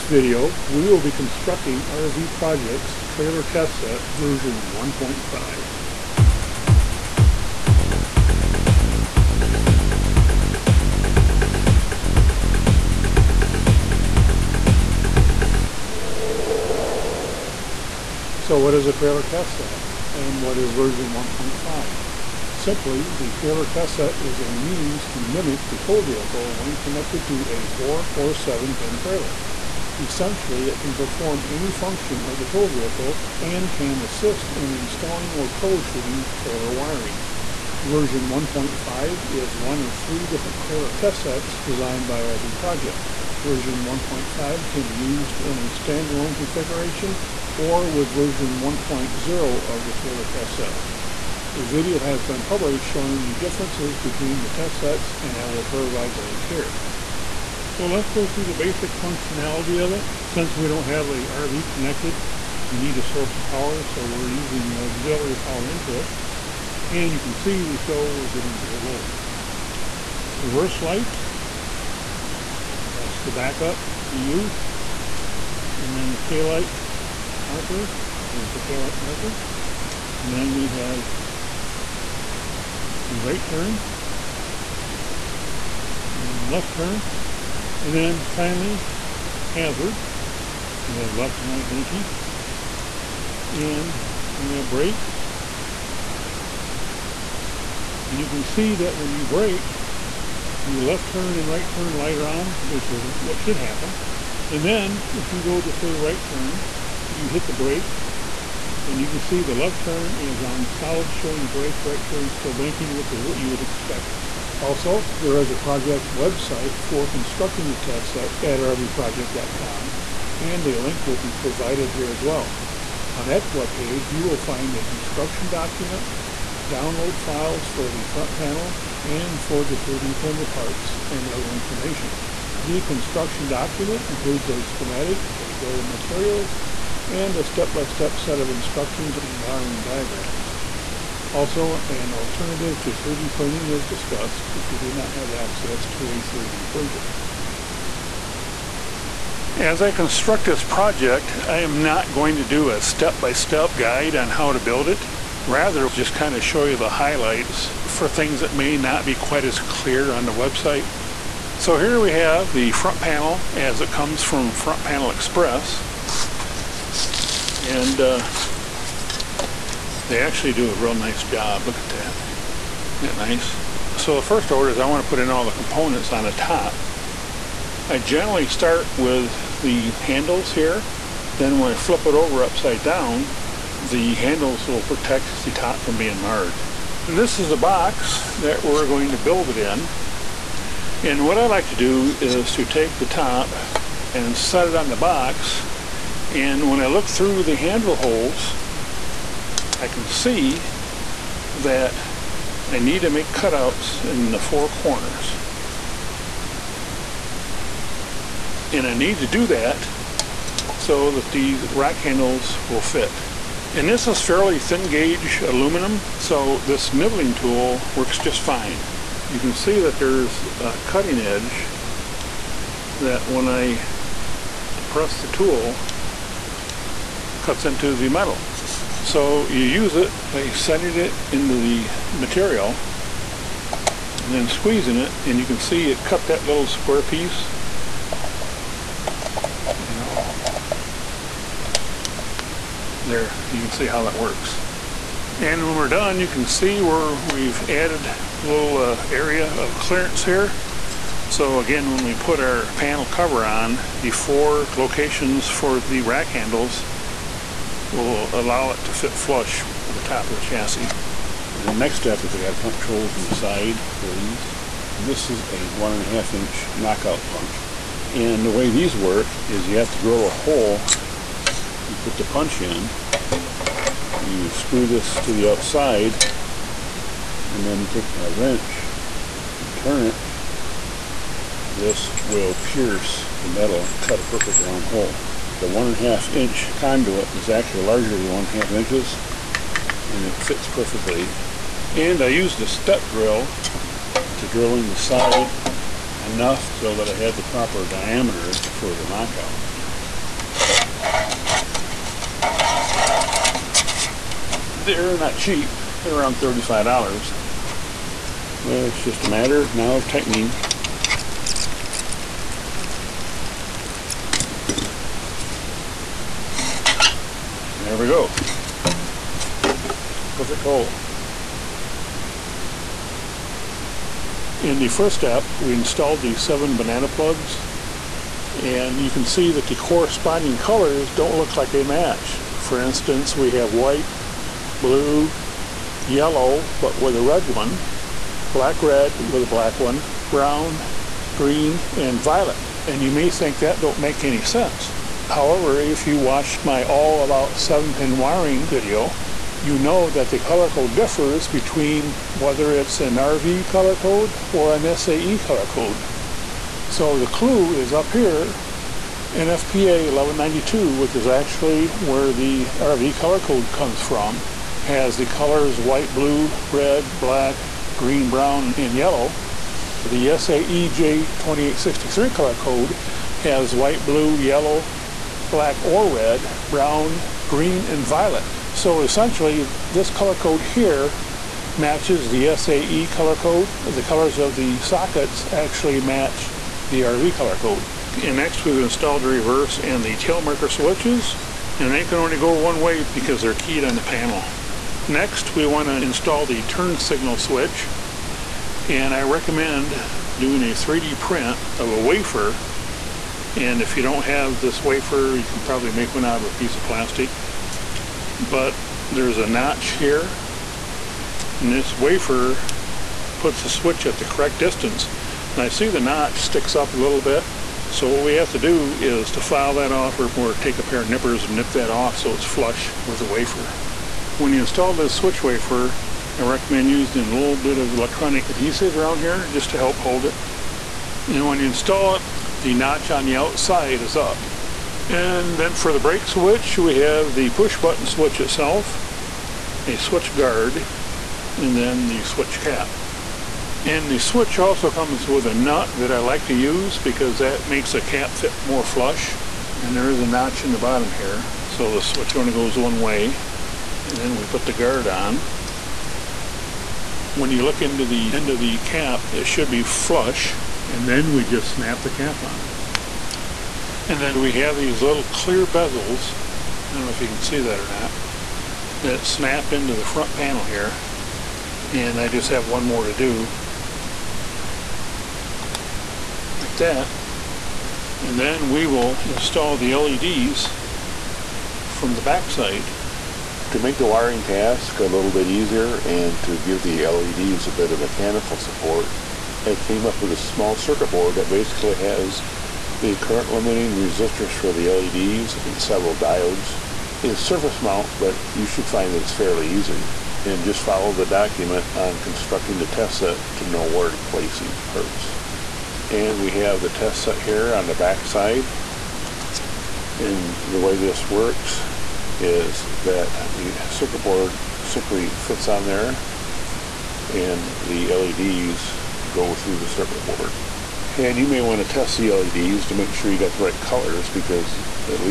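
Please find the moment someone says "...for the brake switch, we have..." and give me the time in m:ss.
7:15.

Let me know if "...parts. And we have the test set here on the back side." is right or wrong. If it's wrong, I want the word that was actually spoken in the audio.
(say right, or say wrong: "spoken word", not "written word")
right.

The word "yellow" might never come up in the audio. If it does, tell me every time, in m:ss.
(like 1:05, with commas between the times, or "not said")
5:36, 6:08, 6:14.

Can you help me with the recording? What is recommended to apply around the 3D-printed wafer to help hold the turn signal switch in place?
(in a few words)
electronic adhesive.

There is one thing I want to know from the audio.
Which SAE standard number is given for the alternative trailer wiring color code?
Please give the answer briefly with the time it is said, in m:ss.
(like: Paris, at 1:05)
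SAE J2863, at 6:10.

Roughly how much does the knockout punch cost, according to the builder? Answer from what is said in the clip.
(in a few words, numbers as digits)
$35.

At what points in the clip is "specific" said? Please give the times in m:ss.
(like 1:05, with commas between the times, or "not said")
not said.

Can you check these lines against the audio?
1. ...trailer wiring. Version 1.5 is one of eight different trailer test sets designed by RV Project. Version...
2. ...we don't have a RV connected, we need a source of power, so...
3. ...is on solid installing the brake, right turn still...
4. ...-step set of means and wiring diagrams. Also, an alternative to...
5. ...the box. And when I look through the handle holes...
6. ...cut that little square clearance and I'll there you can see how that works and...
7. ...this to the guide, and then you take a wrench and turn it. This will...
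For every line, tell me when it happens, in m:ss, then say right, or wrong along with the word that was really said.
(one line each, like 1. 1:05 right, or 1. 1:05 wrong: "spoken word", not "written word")
1. 0:36 wrong: "three", not "eight"
2. 1:00 right
3. 1:50 wrong: "showing", not "installing"
4. 2:18 wrong: "instructions", not "means"
5. 3:14 right
6. 3:56 wrong: "piece", not "clearance"
7. 4:34 wrong: "outside", not "guide".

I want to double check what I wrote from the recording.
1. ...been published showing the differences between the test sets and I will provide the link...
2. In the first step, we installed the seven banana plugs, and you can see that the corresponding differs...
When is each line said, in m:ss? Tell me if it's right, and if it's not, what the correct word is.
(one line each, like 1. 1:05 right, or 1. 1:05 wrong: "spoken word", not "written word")
1. 0:52 right
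2. 5:24 wrong: "colors", not "differs".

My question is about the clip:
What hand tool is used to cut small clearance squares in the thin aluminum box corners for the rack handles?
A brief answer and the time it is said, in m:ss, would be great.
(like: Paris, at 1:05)
nibbling tool, at 3:36.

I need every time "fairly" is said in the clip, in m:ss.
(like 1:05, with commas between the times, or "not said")
3:34, 8:19.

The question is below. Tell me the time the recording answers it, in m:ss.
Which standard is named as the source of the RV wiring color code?
5:59.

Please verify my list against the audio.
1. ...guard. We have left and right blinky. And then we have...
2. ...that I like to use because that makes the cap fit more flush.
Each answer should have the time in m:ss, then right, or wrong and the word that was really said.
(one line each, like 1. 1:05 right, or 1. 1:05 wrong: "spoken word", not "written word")
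1. 1:29 wrong: "hazard", not "guard"
2. 7:25 right.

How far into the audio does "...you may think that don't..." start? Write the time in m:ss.
5:43.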